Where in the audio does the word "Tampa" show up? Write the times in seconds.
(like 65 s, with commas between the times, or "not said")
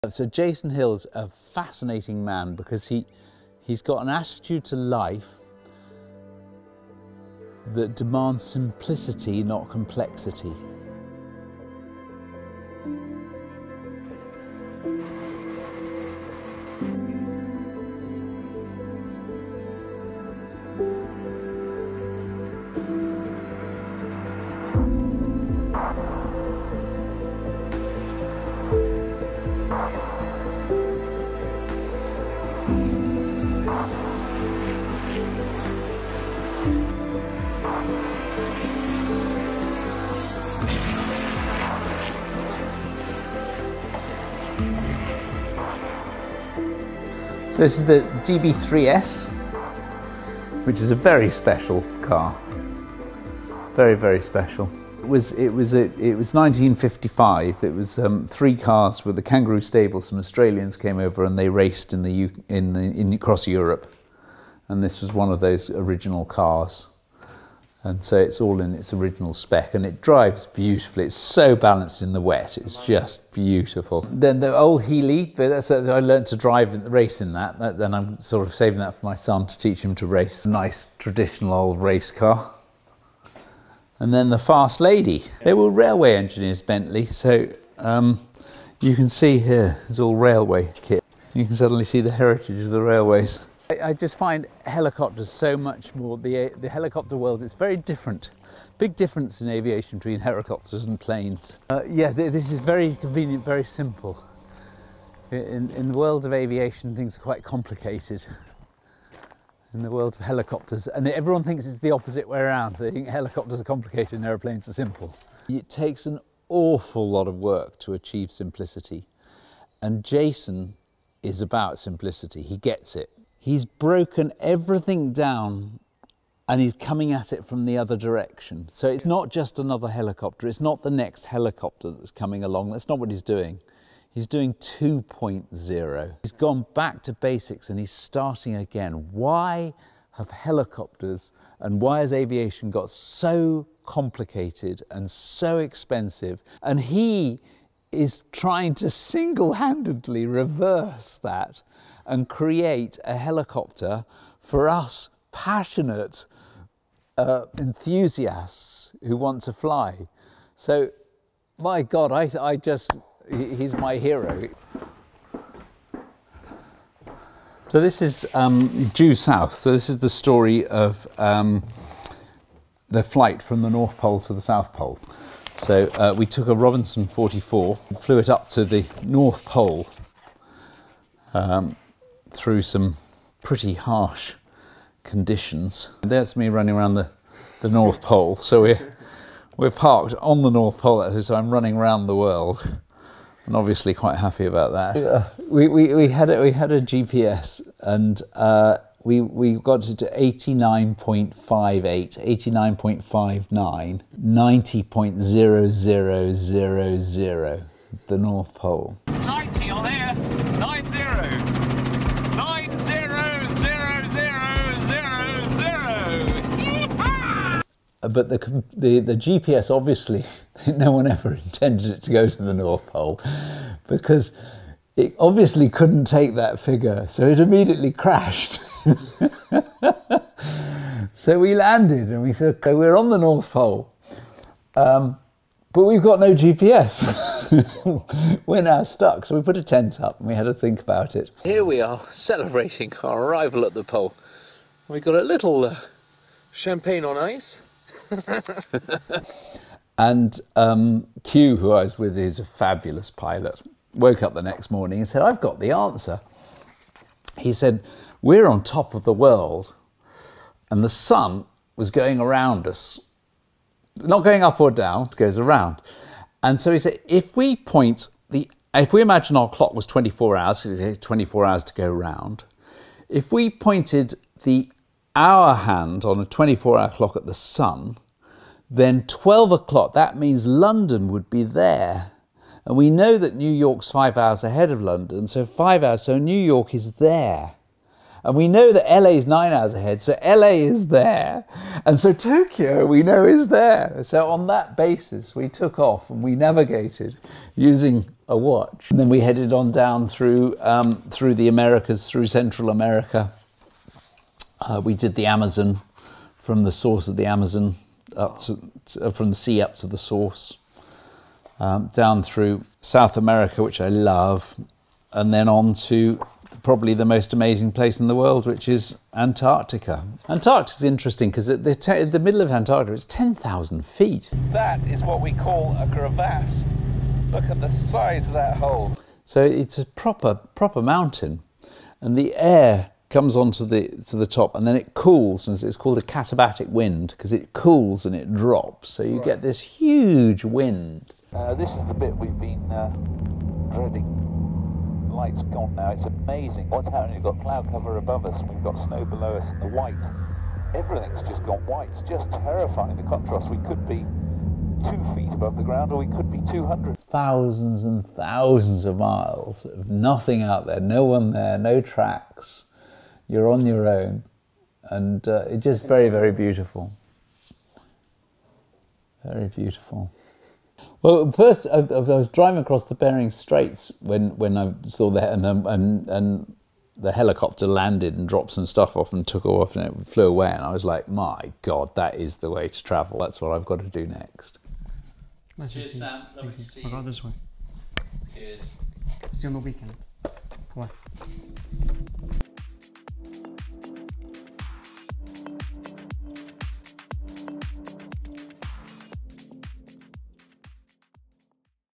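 not said.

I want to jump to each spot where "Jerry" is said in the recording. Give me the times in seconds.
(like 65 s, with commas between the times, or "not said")
not said.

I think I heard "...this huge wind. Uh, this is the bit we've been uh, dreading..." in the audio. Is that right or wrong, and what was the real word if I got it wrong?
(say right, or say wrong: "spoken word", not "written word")
right.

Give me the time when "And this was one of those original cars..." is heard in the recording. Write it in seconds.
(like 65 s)
64 s.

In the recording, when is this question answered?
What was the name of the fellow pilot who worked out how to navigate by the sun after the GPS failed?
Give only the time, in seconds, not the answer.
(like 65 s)
251 s.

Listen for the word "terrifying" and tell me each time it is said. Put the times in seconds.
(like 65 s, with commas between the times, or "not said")
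352 s.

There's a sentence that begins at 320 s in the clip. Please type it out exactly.
Antarctica is interesting because at the, the, middle of Antarctica, it's 10,000 feet.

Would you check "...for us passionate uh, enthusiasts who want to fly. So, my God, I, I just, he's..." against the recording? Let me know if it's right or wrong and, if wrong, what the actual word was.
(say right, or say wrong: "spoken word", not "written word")
right.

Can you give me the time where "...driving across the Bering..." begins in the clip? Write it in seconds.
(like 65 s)
372 s.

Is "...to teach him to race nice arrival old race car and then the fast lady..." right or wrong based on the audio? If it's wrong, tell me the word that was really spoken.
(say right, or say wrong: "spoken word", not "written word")
wrong: "traditional", not "arrival".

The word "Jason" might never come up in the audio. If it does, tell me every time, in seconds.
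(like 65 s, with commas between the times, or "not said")
0 s, 120 s.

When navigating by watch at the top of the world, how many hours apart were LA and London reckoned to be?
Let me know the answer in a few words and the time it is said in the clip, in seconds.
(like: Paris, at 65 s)
9, at 289 s.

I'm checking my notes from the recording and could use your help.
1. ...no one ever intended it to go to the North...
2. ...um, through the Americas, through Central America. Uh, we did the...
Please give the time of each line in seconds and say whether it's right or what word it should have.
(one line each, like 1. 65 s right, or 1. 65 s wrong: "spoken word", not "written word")
1. 220 s right
2. 300 s right.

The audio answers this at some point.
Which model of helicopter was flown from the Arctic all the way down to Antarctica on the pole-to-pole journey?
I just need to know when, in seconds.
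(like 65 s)
176 s.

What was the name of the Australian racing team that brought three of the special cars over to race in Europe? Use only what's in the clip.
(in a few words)
Kangaroo Stable.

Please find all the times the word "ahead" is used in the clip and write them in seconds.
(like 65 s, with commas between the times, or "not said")
284 s, 289 s.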